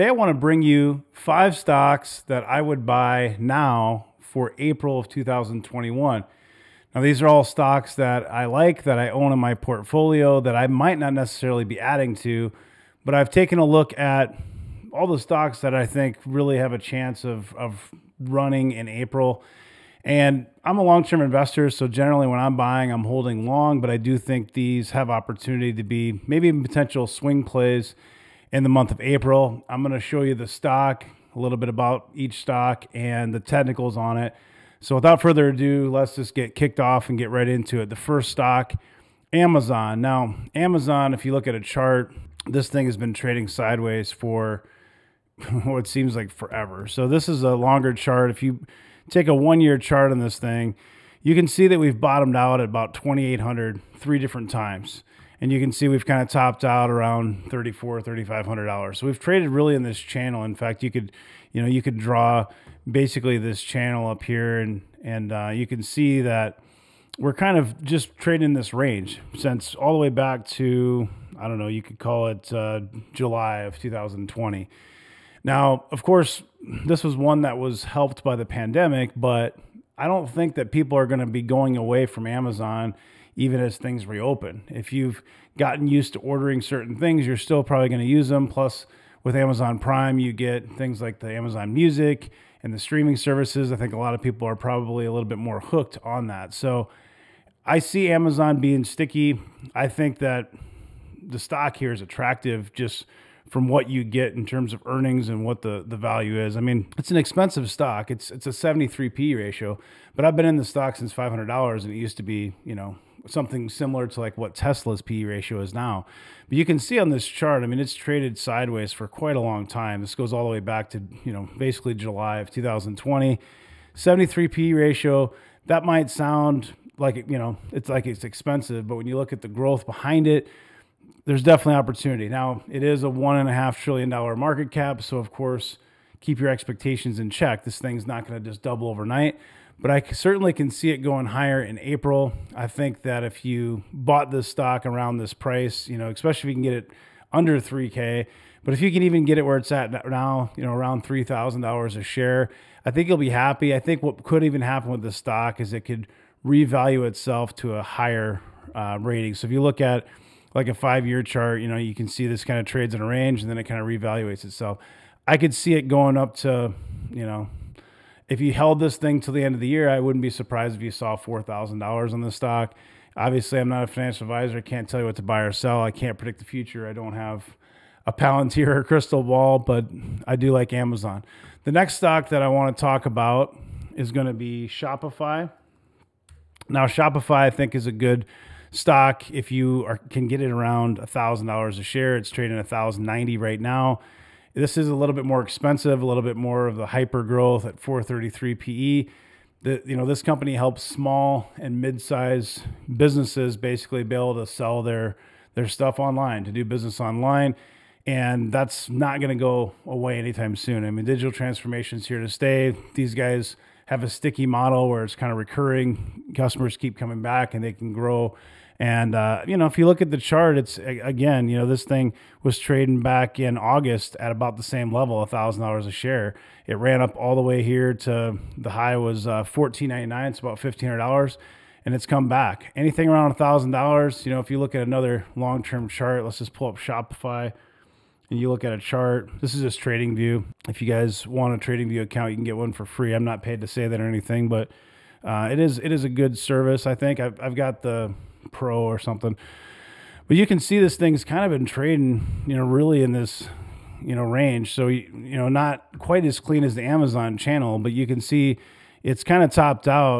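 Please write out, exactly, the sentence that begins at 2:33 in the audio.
I think what could even happen with the stock is it could revalue itself to a higher uh, rating.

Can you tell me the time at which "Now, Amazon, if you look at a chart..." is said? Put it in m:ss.
0:40.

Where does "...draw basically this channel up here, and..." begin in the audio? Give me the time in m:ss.
1:01.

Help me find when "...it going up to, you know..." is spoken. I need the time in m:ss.
2:45.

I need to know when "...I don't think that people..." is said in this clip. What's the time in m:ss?
1:19.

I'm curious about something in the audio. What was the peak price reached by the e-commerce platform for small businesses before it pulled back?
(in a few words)
$1,499.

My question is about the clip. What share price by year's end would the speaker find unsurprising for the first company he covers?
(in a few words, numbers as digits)
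$4,000.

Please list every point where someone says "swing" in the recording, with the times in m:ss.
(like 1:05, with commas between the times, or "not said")
0:27.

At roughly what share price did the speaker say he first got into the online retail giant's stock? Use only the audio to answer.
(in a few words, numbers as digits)
$500.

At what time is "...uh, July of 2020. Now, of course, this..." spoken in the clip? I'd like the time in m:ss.
1:12.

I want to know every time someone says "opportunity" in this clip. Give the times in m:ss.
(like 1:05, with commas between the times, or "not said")
0:25, 2:11.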